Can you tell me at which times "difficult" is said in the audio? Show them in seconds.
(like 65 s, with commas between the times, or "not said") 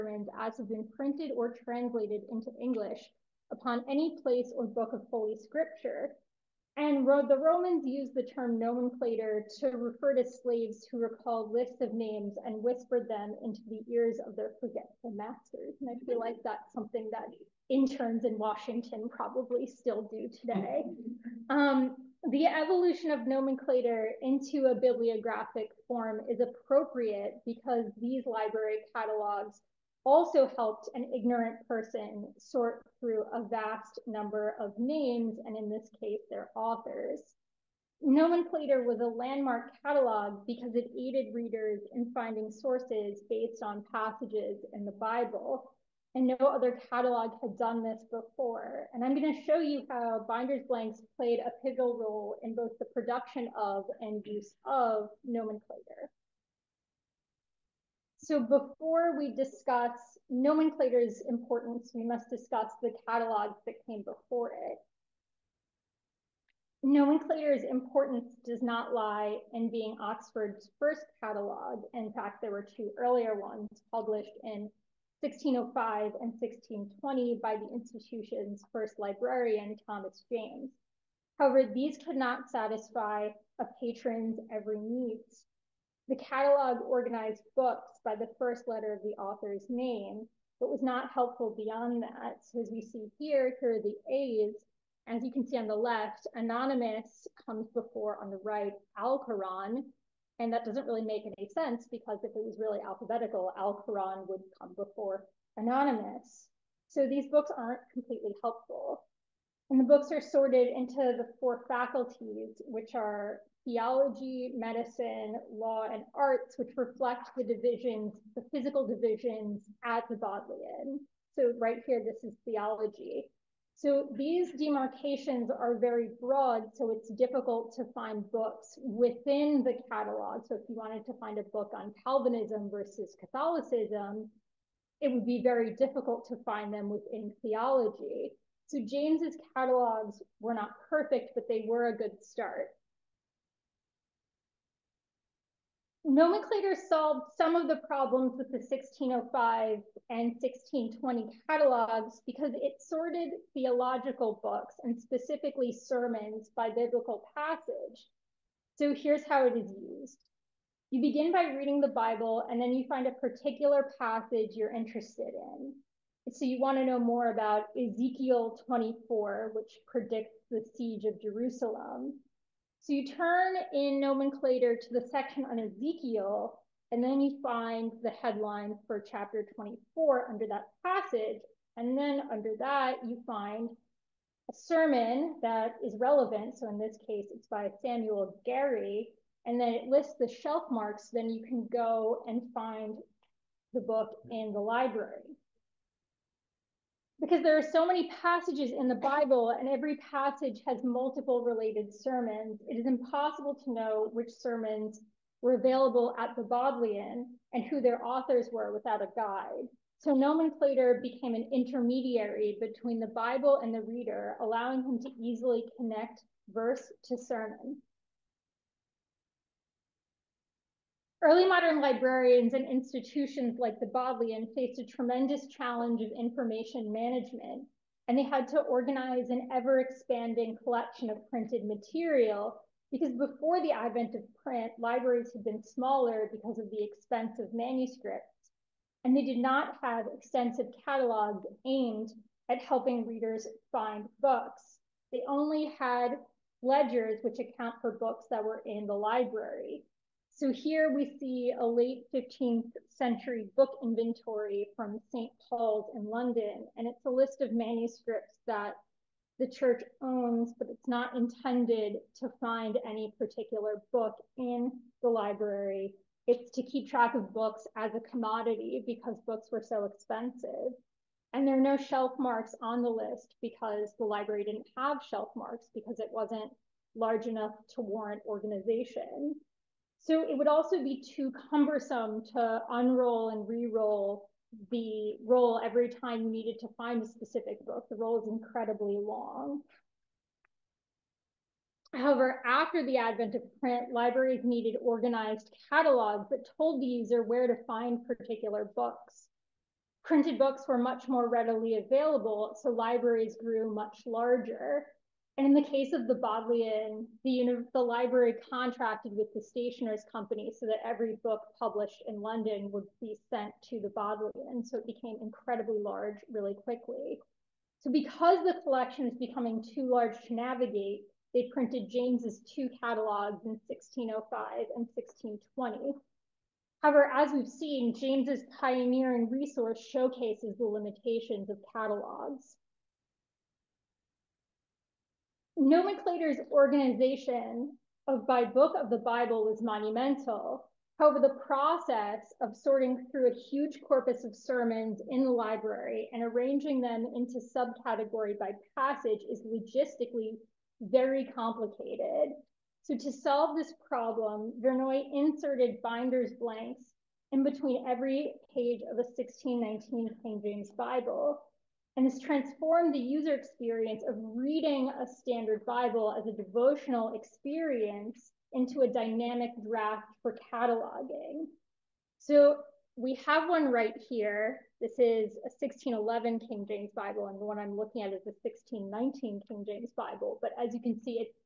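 127 s, 135 s.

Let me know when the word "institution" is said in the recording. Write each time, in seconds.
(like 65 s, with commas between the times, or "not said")
77 s, 222 s.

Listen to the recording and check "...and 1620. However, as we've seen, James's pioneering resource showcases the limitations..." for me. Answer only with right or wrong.
right.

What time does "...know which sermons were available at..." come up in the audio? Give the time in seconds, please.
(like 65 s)
203 s.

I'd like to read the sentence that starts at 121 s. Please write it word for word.
So right here, this is theology.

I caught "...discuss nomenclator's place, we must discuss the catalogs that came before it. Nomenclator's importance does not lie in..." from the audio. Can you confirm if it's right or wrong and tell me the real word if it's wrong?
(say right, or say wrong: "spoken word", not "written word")
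wrong: "importance", not "place".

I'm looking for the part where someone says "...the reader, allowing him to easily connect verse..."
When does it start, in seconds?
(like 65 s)
213 s.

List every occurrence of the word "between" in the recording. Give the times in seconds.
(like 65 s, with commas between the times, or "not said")
212 s, 357 s.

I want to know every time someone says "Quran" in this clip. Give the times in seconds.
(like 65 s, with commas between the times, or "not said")
98 s, 103 s.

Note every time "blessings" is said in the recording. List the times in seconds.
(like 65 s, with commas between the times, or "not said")
not said.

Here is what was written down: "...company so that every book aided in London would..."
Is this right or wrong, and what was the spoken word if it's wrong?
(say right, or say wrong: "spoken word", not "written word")
wrong: "published", not "aided".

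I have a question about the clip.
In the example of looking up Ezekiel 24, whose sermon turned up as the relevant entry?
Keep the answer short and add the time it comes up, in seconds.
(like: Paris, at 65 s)
Samuel Gary, at 187 s.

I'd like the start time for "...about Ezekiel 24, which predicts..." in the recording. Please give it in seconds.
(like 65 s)
167 s.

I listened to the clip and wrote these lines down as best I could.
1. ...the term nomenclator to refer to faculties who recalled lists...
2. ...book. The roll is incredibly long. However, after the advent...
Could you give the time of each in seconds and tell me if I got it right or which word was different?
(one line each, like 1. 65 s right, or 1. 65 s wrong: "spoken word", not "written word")
1. 8 s wrong: "slaves", not "faculties"
2. 287 s right.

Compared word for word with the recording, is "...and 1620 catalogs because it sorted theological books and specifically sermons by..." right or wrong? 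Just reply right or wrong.
right.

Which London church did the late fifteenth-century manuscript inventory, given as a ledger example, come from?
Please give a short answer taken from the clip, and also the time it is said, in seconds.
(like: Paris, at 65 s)
St. Paul's, at 255 s.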